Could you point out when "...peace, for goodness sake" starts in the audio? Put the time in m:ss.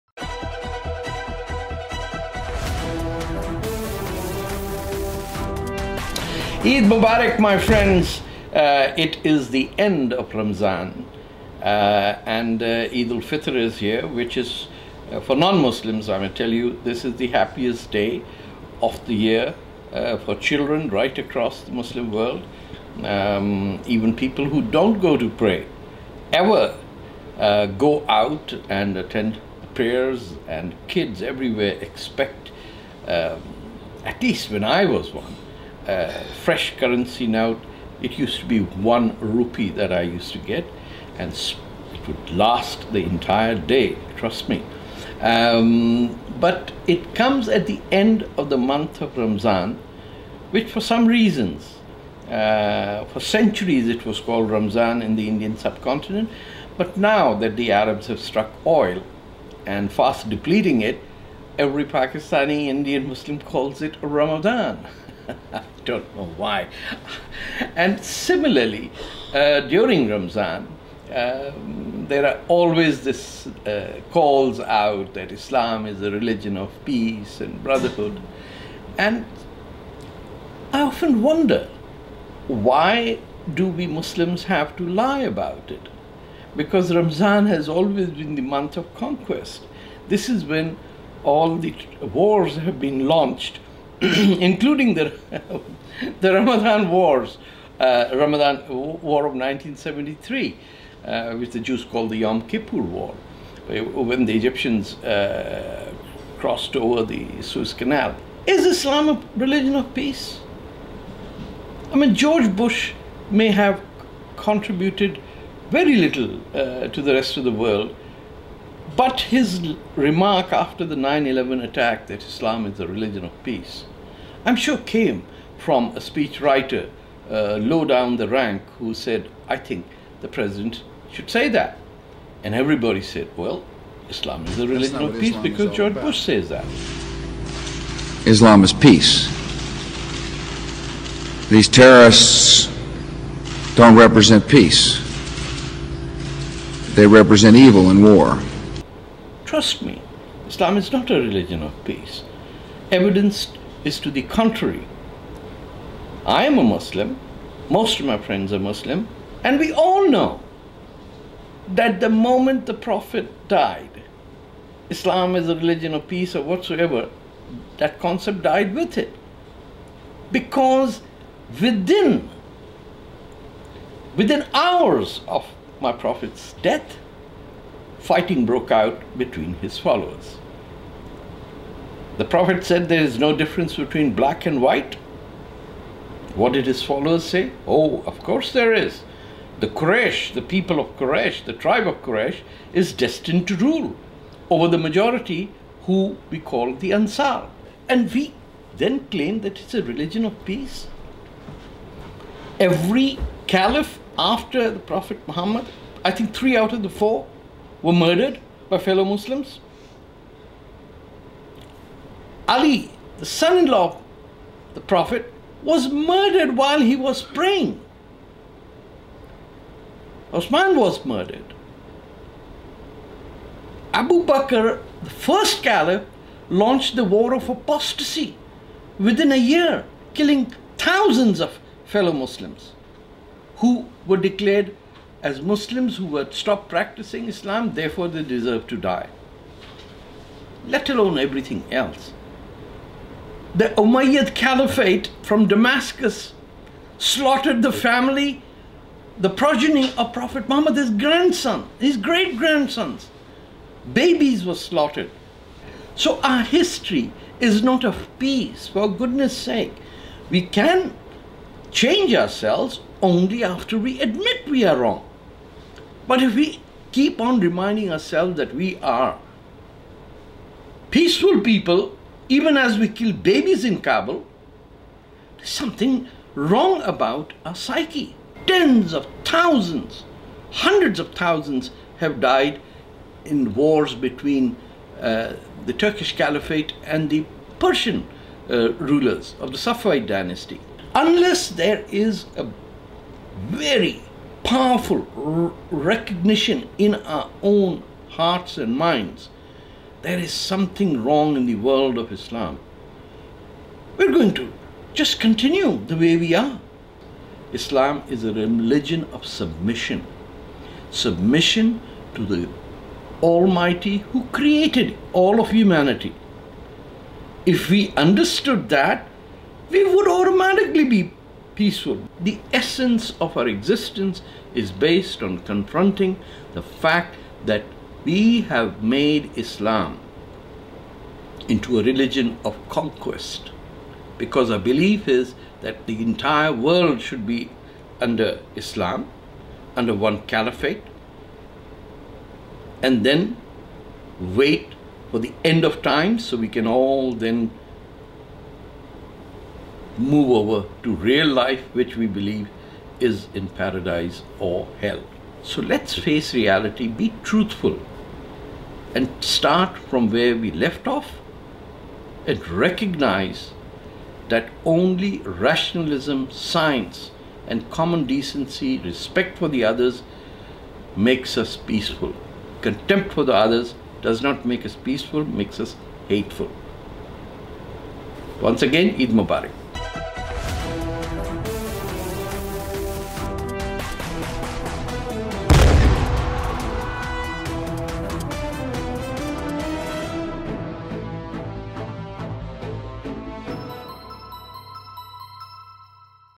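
4:18.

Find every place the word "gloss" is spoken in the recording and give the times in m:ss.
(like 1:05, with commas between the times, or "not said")
not said.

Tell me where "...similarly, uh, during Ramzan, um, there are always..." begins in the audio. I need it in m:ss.
1:08.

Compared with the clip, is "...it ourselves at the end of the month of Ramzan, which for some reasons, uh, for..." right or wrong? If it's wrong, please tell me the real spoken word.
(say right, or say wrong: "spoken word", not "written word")
wrong: "comes", not "ourselves".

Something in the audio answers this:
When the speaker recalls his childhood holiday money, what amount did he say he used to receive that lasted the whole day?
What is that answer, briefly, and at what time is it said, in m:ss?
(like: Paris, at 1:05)
1 rupee, at 0:38.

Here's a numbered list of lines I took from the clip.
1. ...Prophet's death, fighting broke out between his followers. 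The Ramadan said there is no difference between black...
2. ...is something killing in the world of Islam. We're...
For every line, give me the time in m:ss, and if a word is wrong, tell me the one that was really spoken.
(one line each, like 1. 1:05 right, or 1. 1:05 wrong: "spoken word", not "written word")
1. 2:55 wrong: "Prophet", not "Ramadan"
2. 5:00 wrong: "wrong", not "killing".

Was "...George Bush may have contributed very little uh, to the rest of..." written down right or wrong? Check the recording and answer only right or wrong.
right.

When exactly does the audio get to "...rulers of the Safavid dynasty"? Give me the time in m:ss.
4:48.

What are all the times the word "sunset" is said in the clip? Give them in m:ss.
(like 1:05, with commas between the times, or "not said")
not said.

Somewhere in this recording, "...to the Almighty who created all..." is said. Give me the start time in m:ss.
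5:12.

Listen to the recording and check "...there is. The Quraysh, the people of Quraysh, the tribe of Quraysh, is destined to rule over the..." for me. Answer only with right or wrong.
right.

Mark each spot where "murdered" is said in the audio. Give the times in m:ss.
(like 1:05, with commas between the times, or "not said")
3:27, 3:35, 3:41.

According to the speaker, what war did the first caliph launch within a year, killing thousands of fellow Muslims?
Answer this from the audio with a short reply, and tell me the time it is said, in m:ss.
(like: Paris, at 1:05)
War of apostasy, at 3:47.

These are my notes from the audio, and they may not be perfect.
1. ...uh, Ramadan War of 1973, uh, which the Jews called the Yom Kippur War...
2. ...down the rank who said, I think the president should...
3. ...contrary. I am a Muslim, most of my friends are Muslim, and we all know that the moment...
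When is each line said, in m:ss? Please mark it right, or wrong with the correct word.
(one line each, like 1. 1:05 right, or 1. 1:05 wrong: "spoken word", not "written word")
1. 1:37 right
2. 2:07 right
3. 2:34 right.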